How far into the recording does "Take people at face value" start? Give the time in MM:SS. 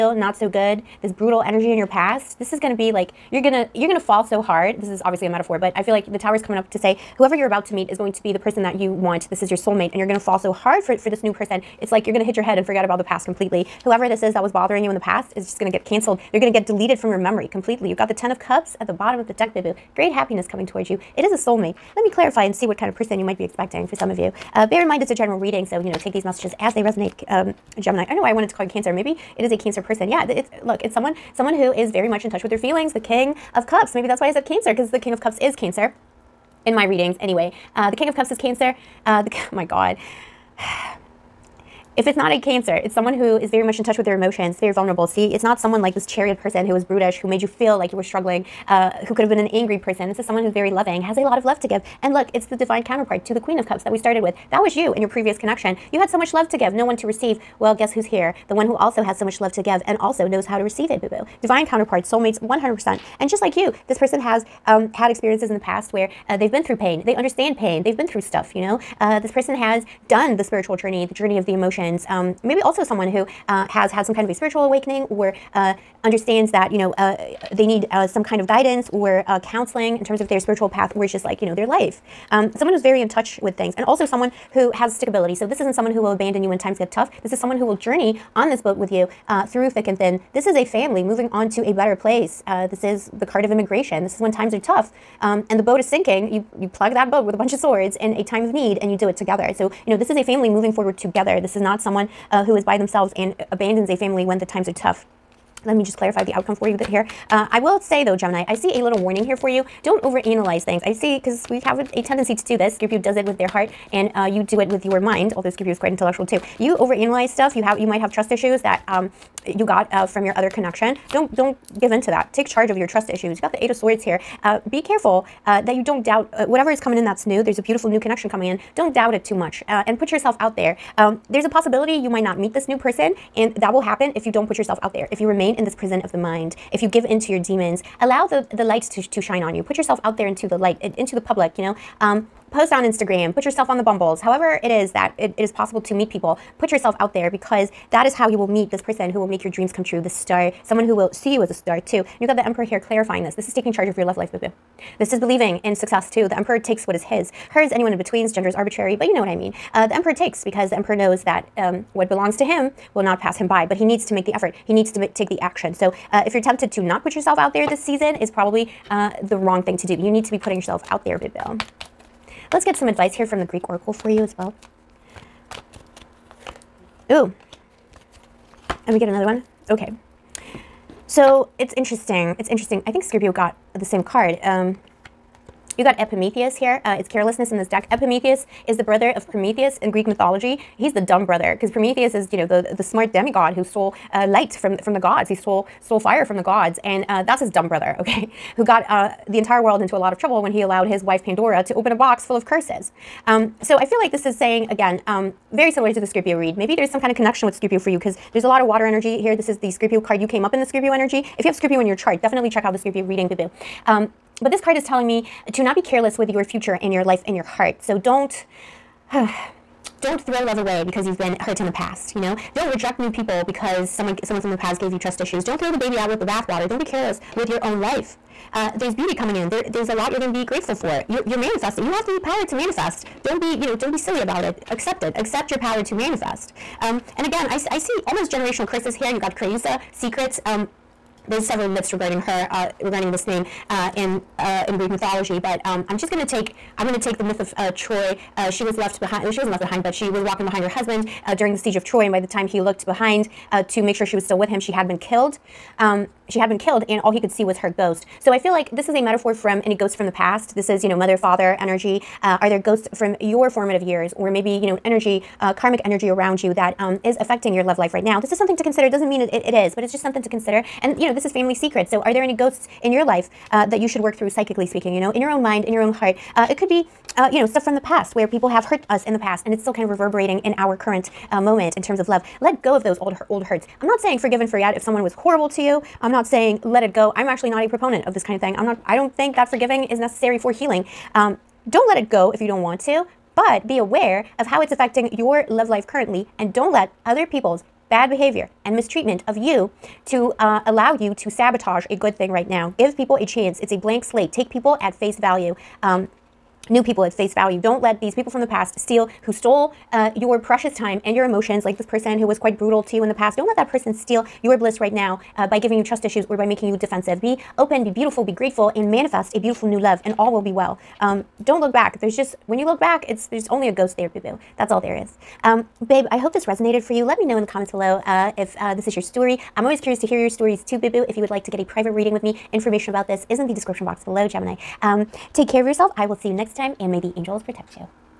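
05:04.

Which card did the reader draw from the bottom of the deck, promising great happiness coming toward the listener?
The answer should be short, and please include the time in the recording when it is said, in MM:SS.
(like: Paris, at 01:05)
Ten of Cups, at 00:18.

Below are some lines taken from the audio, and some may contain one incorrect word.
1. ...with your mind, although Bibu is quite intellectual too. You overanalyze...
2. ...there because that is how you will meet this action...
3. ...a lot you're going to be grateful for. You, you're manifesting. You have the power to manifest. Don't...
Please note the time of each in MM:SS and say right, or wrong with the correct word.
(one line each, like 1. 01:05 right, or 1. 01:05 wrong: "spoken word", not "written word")
1. 01:54 wrong: "Scorpio", not "Bibu"
2. 02:27 wrong: "person", not "action"
3. 03:49 right.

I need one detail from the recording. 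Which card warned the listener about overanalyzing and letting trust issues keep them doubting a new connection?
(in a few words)
Eight of Swords.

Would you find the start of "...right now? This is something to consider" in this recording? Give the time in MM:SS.
04:27.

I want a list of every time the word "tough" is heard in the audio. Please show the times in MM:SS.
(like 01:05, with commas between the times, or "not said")
01:26, 01:34, 01:44.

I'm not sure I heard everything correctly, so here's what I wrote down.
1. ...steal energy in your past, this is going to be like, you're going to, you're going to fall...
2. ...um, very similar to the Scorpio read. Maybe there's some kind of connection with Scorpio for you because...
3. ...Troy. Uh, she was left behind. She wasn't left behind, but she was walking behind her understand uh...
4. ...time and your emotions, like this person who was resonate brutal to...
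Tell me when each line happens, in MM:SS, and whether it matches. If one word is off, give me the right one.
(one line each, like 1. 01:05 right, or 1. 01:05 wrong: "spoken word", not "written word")
1. 00:01 wrong: "brutal", not "steal"
2. 03:25 right
3. 04:07 wrong: "husband", not "understand"
4. 05:10 wrong: "quite", not "resonate".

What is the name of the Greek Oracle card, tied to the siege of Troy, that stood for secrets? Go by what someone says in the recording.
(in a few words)
Creusa.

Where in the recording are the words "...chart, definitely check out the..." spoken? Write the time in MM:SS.
03:31.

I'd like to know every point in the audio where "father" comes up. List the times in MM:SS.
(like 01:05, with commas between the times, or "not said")
04:21.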